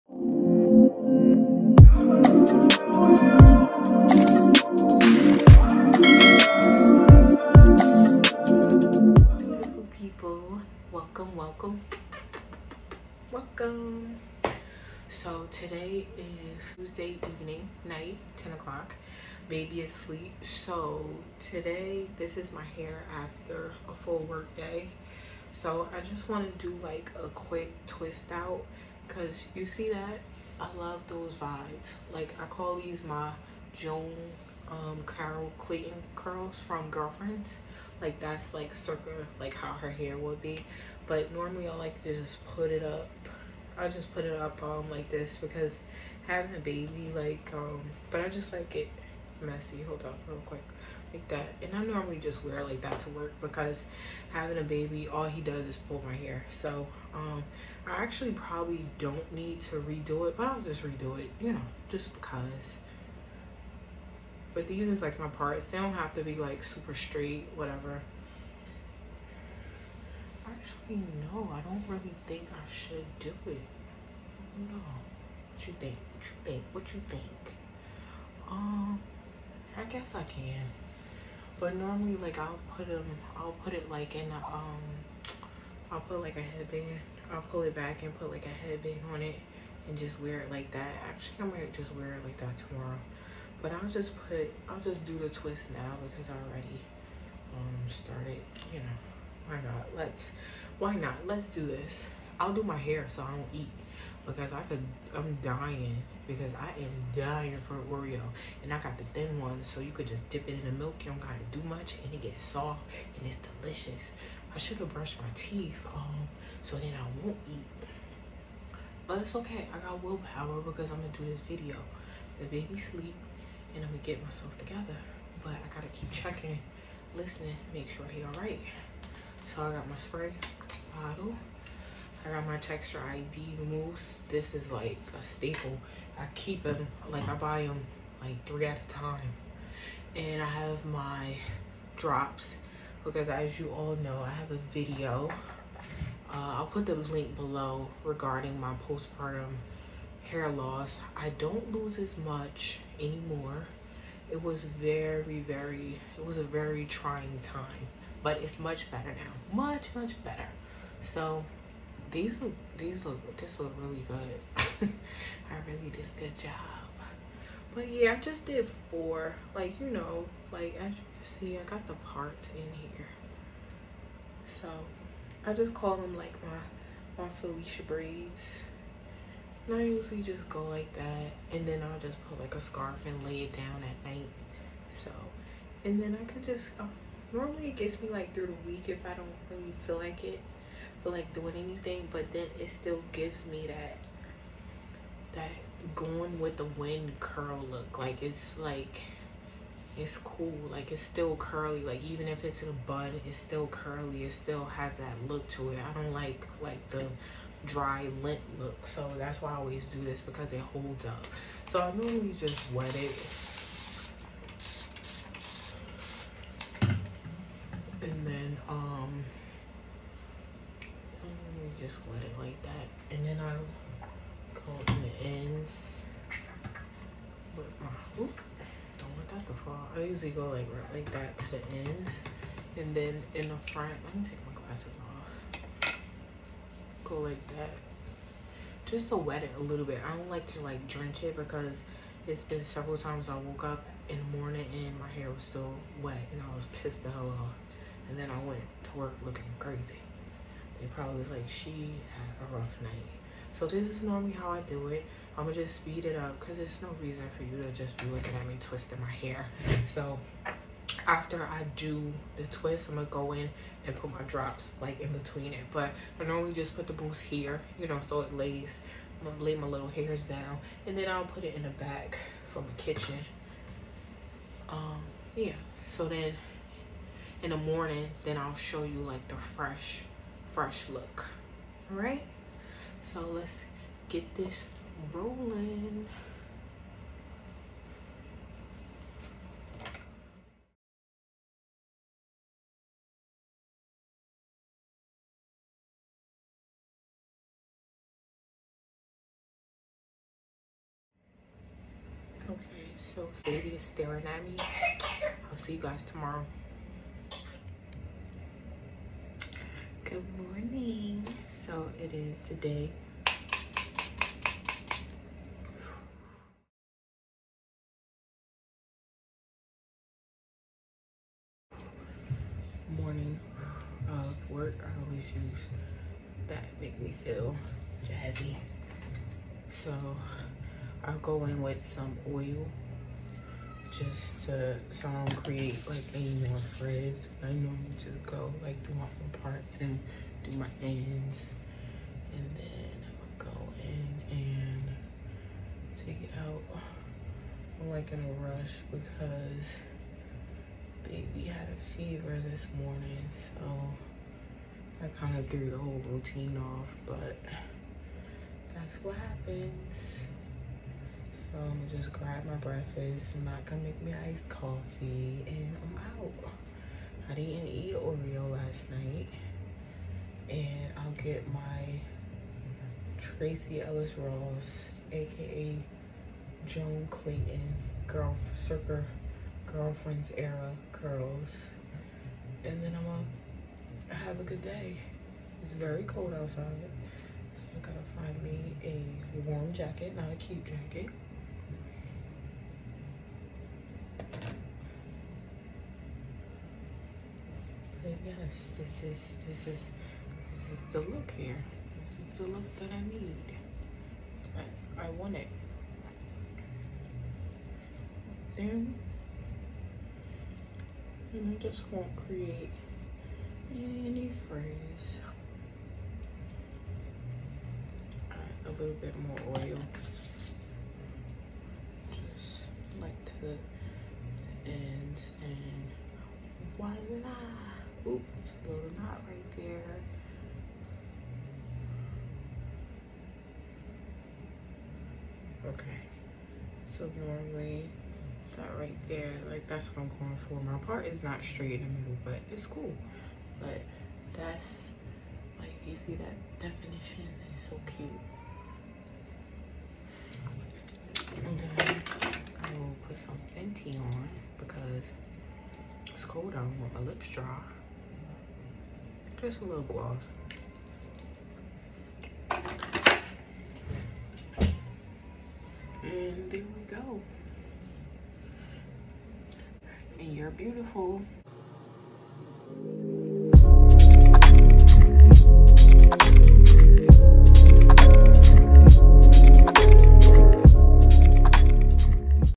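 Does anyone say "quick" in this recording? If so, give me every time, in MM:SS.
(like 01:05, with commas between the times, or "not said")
00:27, 00:50.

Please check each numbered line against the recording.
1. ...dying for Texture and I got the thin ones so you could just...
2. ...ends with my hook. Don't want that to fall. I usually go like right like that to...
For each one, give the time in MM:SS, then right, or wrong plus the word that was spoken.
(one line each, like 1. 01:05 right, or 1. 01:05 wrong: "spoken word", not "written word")
1. 01:47 wrong: "Oreo", not "Texture"
2. 03:45 right.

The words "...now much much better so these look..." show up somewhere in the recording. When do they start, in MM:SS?
02:39.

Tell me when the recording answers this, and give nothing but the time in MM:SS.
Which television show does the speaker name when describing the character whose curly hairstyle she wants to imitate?
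00:36.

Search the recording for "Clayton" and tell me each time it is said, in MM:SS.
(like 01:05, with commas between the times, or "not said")
00:35, 06:17.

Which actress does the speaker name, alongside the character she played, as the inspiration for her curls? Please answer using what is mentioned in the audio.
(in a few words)
Tracee Ellis Ross.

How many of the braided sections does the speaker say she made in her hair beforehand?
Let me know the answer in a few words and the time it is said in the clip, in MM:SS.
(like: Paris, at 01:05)
4, at 02:48.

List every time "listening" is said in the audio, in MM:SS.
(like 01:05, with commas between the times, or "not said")
02:07.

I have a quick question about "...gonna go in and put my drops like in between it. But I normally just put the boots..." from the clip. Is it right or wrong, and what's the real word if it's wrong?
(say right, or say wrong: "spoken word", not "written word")
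right.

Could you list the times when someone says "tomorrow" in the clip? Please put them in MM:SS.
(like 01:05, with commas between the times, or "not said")
01:32, 05:06.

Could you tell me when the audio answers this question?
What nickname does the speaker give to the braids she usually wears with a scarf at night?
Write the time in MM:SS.
02:57.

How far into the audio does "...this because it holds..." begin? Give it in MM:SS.
03:30.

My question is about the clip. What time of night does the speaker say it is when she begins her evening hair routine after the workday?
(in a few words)
10 o'clock.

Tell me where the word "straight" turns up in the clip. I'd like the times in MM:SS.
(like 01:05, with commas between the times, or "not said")
01:06, 07:21.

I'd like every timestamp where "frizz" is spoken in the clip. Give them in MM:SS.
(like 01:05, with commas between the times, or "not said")
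05:36, 06:54.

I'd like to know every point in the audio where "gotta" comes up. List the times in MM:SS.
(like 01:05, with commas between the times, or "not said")
01:51, 02:05, 06:27.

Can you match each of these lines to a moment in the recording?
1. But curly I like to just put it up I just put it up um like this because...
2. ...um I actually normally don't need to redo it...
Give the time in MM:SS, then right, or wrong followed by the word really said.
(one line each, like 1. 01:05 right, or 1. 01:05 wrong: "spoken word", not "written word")
1. 00:41 wrong: "normally", not "curly"
2. 00:57 wrong: "probably", not "normally".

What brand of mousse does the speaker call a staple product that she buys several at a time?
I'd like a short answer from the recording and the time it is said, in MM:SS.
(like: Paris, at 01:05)
Texture ID, at 02:12.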